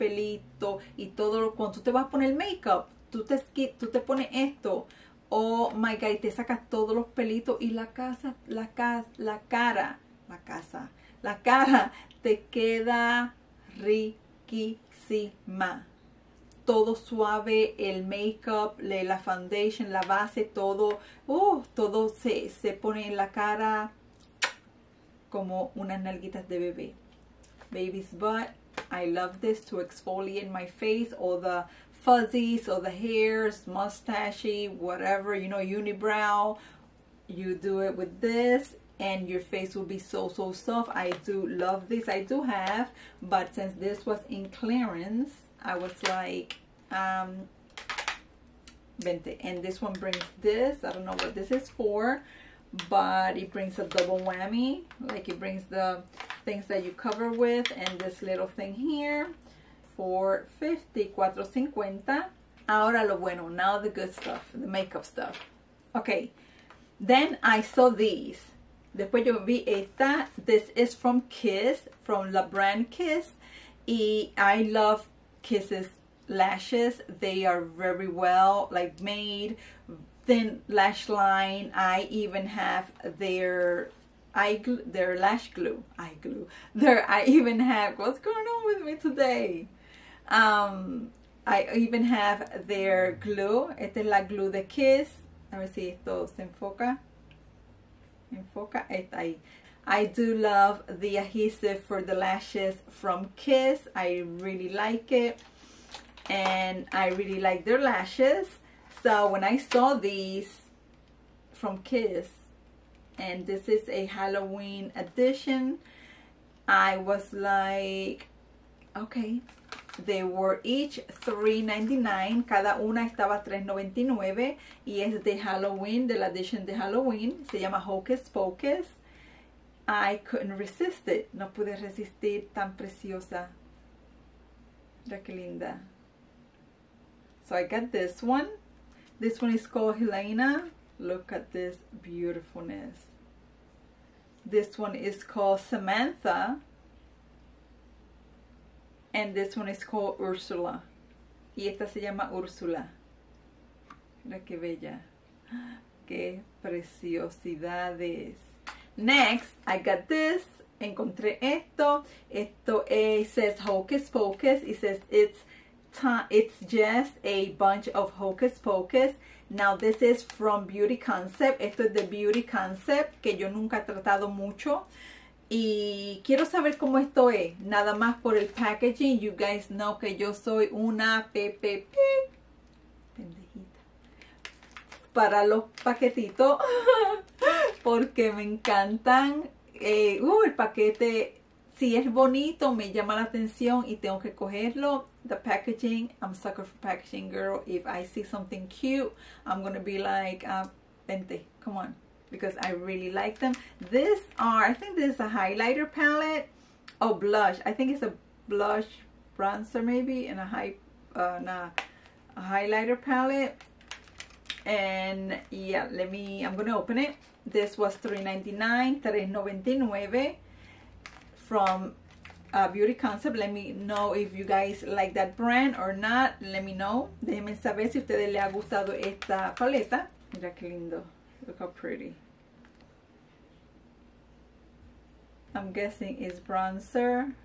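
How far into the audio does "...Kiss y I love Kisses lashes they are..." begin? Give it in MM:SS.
01:12.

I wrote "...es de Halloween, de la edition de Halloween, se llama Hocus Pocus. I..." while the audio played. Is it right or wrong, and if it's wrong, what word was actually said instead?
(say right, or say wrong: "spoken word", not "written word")
right.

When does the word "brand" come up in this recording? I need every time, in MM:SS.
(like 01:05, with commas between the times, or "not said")
01:12, 03:45.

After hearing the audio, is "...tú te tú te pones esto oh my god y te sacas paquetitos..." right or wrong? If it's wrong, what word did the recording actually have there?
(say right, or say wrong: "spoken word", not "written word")
wrong: "todos", not "paquetitos".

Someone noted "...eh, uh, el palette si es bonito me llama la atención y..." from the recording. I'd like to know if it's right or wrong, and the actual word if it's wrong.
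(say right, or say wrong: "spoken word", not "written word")
wrong: "paquete", not "palette".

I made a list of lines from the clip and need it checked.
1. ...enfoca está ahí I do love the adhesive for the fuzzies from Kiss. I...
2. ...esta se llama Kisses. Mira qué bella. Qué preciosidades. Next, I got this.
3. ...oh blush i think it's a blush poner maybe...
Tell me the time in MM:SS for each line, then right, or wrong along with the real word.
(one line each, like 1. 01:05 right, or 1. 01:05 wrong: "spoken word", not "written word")
1. 01:38 wrong: "lashes", not "fuzzies"
2. 02:31 wrong: "Ursula", not "Kisses"
3. 03:27 wrong: "bronzer", not "poner".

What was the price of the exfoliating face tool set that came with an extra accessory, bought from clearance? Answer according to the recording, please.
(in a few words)
50.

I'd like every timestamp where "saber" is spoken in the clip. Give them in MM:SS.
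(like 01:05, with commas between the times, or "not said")
02:56, 03:47.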